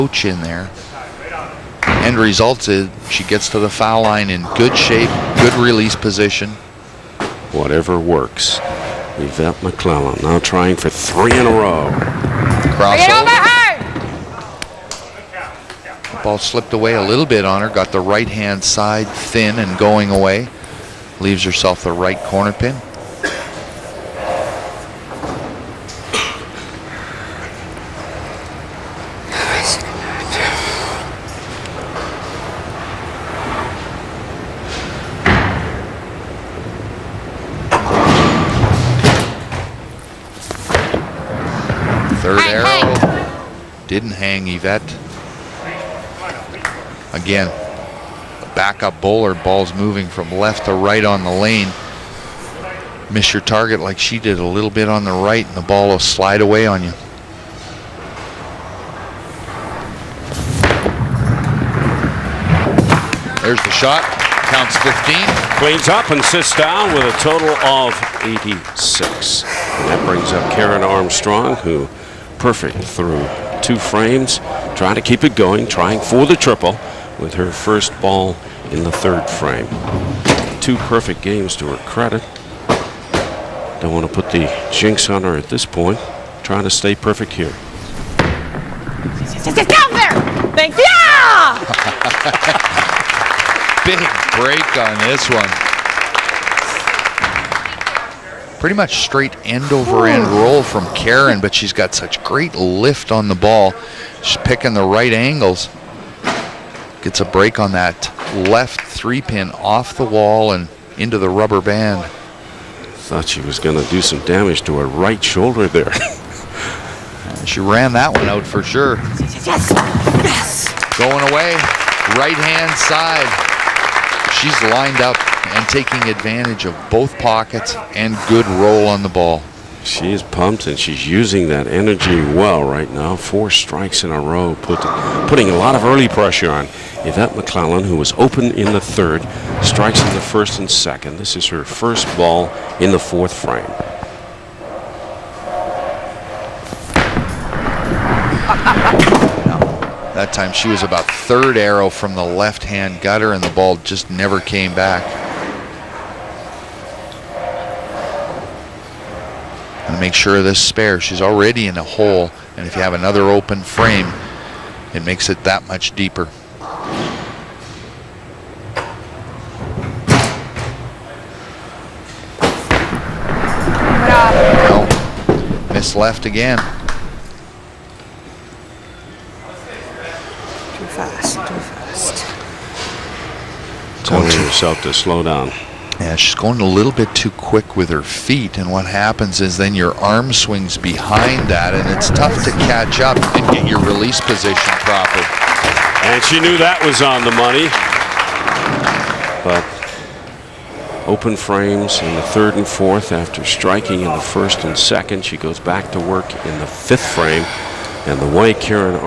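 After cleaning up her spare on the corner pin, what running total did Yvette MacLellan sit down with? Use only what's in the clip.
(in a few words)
86.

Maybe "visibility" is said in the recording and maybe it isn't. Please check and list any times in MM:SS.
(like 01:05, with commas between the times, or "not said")
not said.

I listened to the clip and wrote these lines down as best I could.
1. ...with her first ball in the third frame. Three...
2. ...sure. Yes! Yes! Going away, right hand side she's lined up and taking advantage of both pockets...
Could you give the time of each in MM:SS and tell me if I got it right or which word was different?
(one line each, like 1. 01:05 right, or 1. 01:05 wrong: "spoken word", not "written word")
1. 01:17 wrong: "Two", not "Three"
2. 01:58 right.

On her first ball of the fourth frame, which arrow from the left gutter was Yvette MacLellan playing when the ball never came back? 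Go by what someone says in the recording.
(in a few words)
Third arrow.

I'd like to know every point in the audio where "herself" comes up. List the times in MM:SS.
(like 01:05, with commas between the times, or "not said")
00:21, 03:04.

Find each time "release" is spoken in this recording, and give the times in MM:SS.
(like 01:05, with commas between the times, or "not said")
00:05, 03:13.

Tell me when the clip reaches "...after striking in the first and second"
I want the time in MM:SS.
03:23.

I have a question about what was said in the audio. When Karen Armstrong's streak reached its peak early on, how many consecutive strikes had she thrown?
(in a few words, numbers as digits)
4.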